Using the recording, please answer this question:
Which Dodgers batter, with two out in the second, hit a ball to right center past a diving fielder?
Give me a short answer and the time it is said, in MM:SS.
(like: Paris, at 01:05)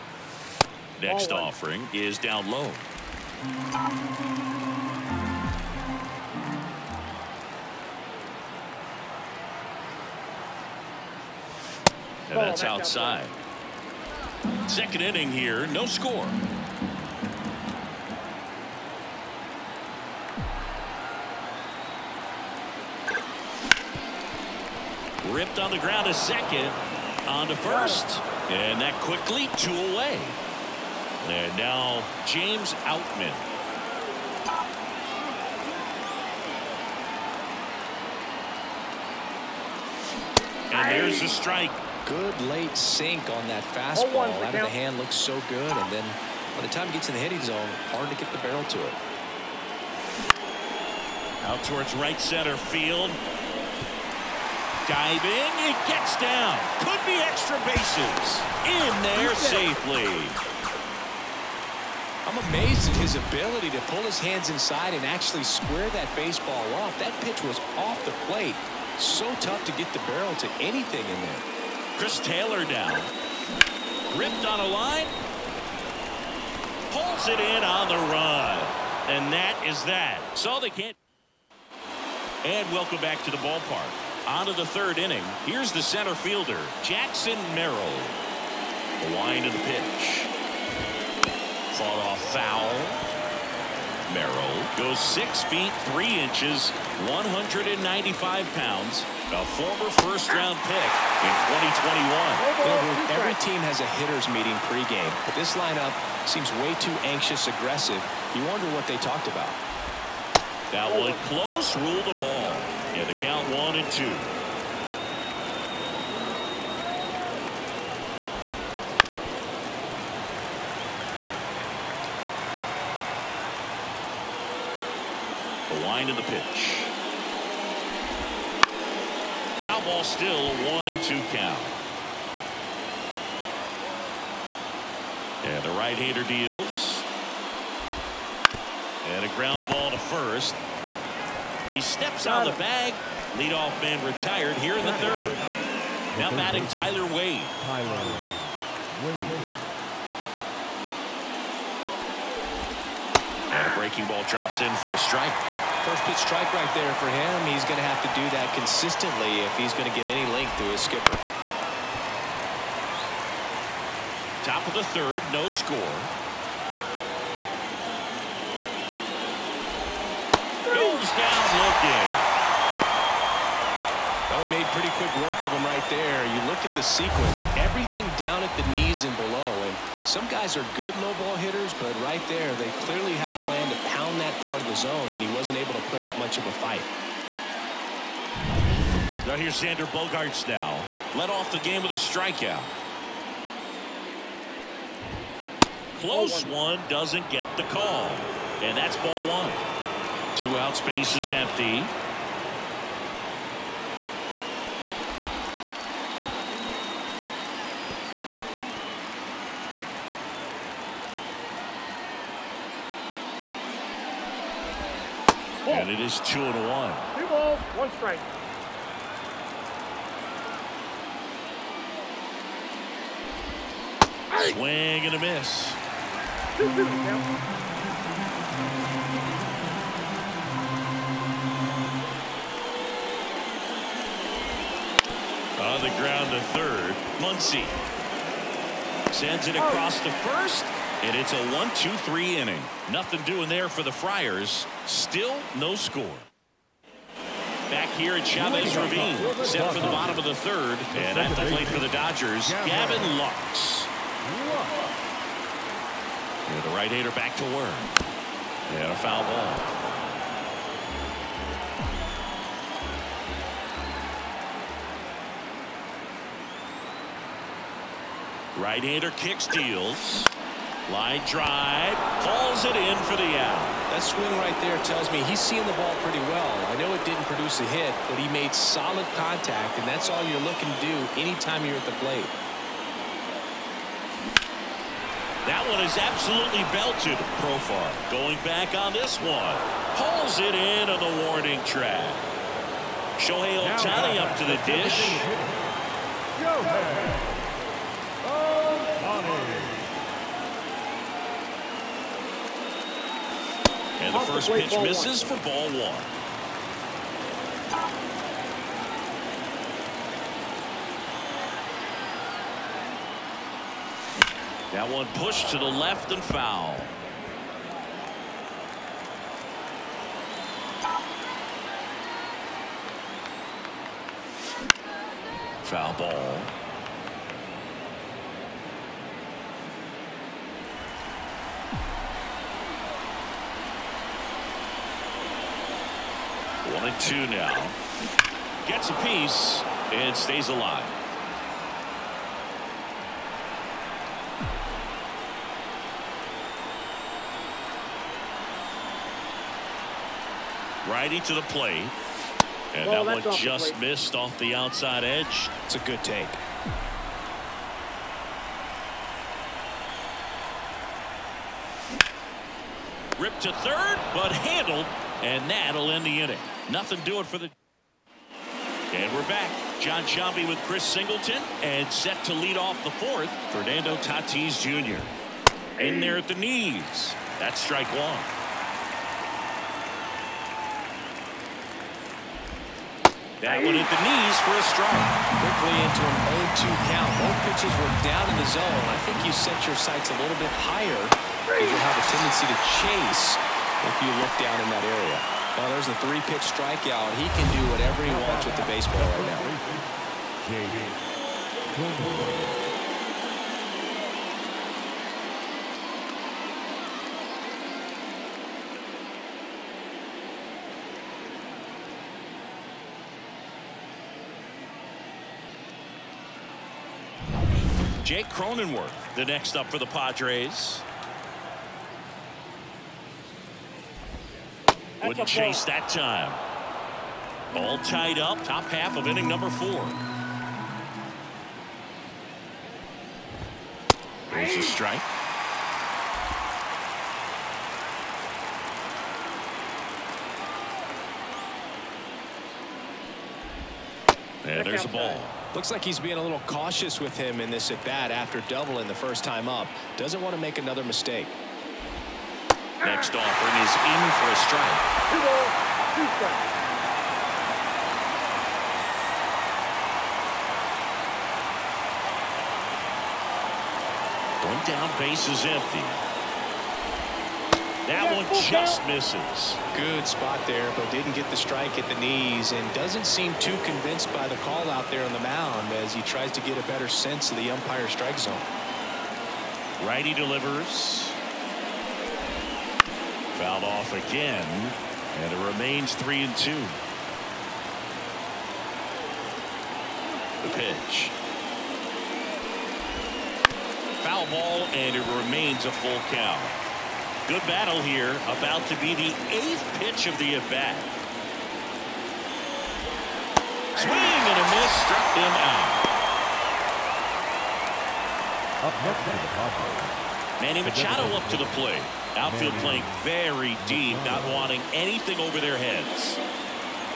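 James Outman, at 00:32.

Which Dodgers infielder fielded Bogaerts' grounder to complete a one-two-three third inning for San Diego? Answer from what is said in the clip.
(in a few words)
Muncy.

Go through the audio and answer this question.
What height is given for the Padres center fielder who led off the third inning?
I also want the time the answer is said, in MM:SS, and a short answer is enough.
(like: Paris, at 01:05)
6 feet 3 inches, at 01:34.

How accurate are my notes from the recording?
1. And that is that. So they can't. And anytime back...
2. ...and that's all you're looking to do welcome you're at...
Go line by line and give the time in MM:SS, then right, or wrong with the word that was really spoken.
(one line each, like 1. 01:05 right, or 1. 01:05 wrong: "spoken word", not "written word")
1. 01:19 wrong: "welcome", not "anytime"
2. 04:39 wrong: "anytime", not "welcome".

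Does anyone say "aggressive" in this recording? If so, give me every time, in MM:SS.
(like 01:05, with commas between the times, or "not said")
01:47.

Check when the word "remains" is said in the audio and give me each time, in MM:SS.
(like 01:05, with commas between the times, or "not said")
08:05, 08:15.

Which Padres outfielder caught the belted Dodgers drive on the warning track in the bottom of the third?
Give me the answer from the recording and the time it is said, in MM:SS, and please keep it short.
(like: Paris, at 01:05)
Profar, at 04:47.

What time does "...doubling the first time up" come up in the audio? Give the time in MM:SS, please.
07:28.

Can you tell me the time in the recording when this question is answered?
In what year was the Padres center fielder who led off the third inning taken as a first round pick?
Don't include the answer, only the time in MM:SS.
01:43.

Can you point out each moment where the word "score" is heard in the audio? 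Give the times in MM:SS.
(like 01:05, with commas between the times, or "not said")
00:15, 02:45, 04:05.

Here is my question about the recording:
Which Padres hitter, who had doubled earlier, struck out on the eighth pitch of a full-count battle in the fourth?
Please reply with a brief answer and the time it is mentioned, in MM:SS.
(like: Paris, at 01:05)
Jake Cronenworth, at 06:58.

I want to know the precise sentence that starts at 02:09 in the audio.
Foul ball still one and two count.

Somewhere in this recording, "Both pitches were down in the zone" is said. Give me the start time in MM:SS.
06:27.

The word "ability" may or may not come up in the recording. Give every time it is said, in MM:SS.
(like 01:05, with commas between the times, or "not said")
01:03.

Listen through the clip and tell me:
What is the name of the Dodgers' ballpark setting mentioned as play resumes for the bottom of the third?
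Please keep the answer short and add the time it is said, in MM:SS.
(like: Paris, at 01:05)
Chavez Ravine, at 04:08.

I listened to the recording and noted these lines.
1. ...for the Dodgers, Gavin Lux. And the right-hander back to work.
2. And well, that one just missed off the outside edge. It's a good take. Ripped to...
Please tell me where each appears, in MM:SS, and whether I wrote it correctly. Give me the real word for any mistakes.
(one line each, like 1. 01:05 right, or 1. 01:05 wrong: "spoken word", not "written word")
1. 04:11 right
2. 05:52 right.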